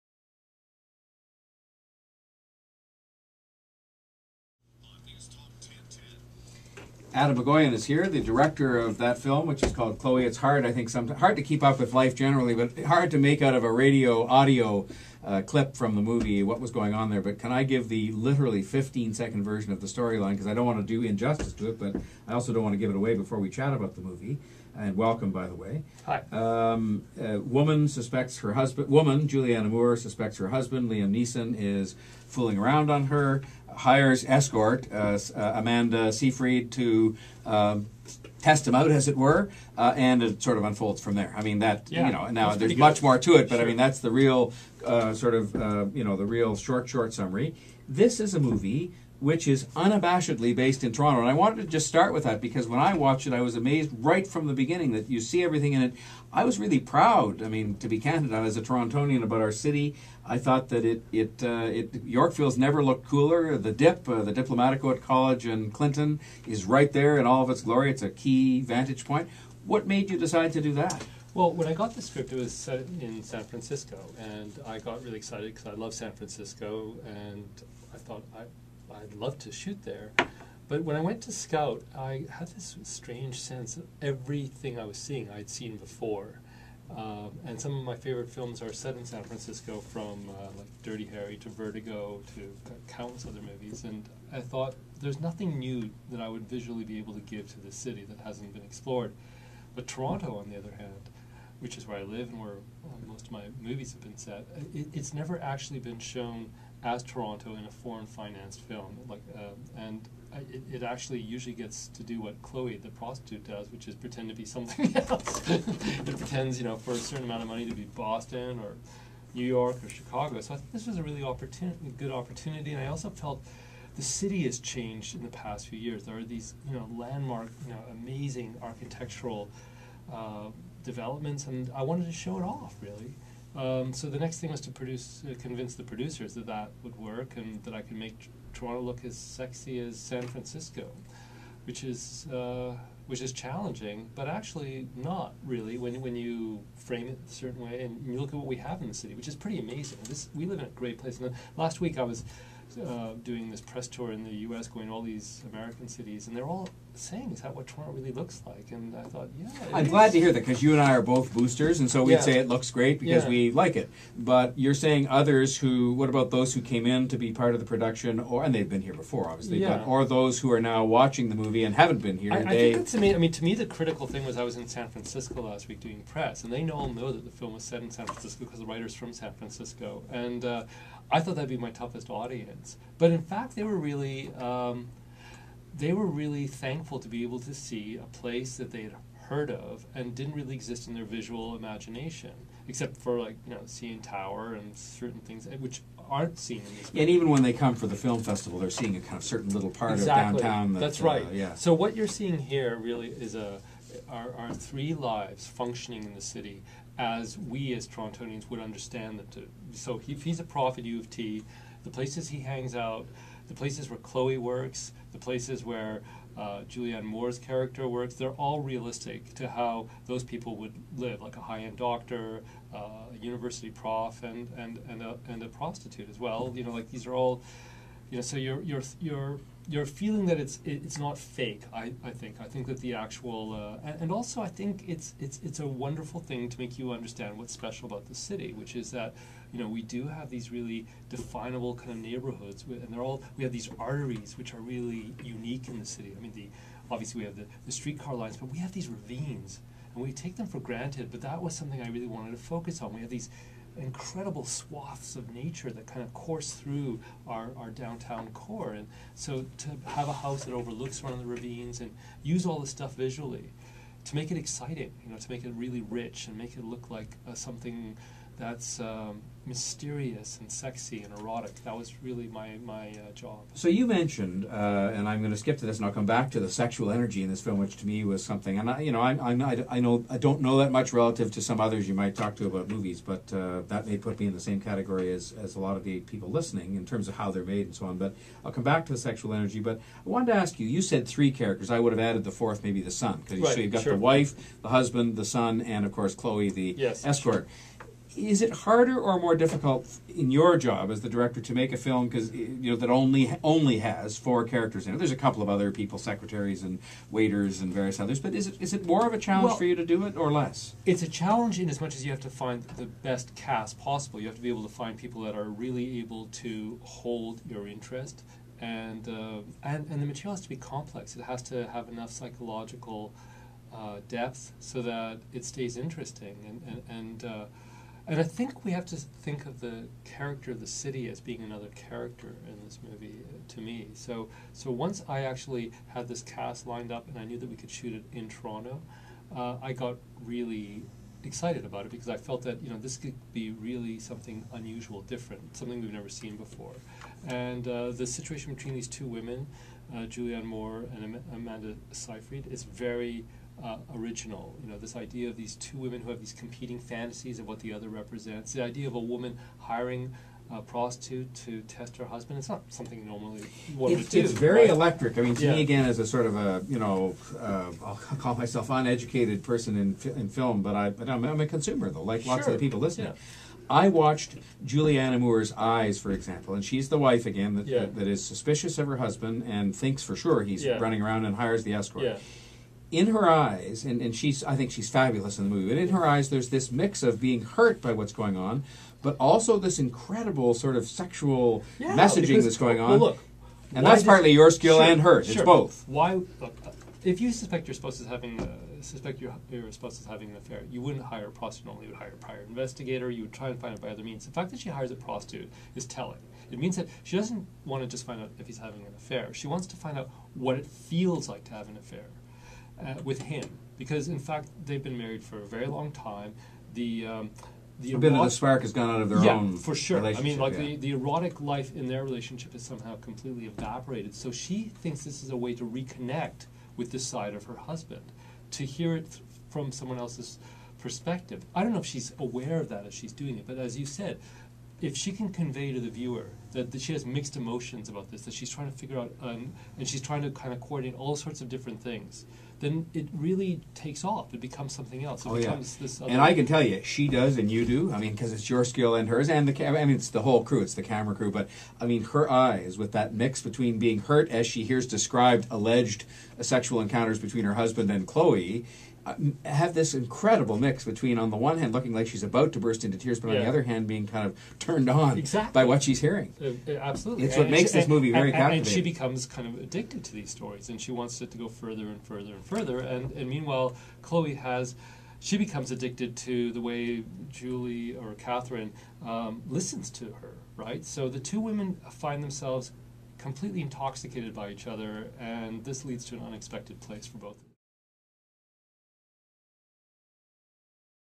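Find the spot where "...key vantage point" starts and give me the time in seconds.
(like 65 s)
68 s.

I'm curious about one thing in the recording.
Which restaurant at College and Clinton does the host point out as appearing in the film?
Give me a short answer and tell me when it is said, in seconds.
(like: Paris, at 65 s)
The Diplomatico, at 64 s.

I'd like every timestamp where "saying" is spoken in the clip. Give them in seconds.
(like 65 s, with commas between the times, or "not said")
156 s, 164 s.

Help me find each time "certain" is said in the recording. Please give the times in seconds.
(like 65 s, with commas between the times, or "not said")
116 s, 147 s, 194 s, 199 s.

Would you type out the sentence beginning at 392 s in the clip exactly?
Well, look, and that's partly your skill sure, and hers.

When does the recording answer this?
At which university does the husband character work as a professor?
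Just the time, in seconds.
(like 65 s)
210 s.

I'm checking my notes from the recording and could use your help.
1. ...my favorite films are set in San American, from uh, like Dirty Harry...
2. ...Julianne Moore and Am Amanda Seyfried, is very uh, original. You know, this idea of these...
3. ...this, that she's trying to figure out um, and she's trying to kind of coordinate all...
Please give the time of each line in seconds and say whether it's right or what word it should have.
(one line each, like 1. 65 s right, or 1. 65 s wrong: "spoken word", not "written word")
1. 87 s wrong: "Francisco", not "American"
2. 350 s right
3. 438 s right.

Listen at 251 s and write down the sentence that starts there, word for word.
But that was something I really wanted to focus on.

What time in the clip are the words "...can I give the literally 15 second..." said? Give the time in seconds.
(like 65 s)
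17 s.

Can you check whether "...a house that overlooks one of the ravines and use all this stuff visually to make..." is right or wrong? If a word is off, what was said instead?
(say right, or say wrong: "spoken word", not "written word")
right.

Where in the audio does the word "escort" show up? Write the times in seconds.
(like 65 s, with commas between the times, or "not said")
34 s, 297 s, 381 s.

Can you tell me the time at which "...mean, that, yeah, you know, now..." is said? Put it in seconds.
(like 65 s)
41 s.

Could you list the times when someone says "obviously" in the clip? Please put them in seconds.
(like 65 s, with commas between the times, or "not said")
169 s, 246 s.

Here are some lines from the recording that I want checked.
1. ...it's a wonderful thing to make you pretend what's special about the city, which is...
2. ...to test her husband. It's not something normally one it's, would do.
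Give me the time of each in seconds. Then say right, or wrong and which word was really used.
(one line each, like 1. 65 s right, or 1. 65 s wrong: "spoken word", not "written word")
1. 235 s wrong: "understand", not "pretend"
2. 361 s right.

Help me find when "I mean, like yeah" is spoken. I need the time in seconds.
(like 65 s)
420 s.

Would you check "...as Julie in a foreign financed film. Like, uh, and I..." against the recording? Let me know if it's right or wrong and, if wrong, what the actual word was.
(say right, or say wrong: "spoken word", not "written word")
wrong: "Toronto", not "Julie".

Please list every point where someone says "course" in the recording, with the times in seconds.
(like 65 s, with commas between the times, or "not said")
256 s, 295 s.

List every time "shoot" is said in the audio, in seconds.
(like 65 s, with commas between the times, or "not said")
79 s, 337 s.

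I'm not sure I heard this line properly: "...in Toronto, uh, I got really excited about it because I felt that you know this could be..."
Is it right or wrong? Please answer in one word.
right.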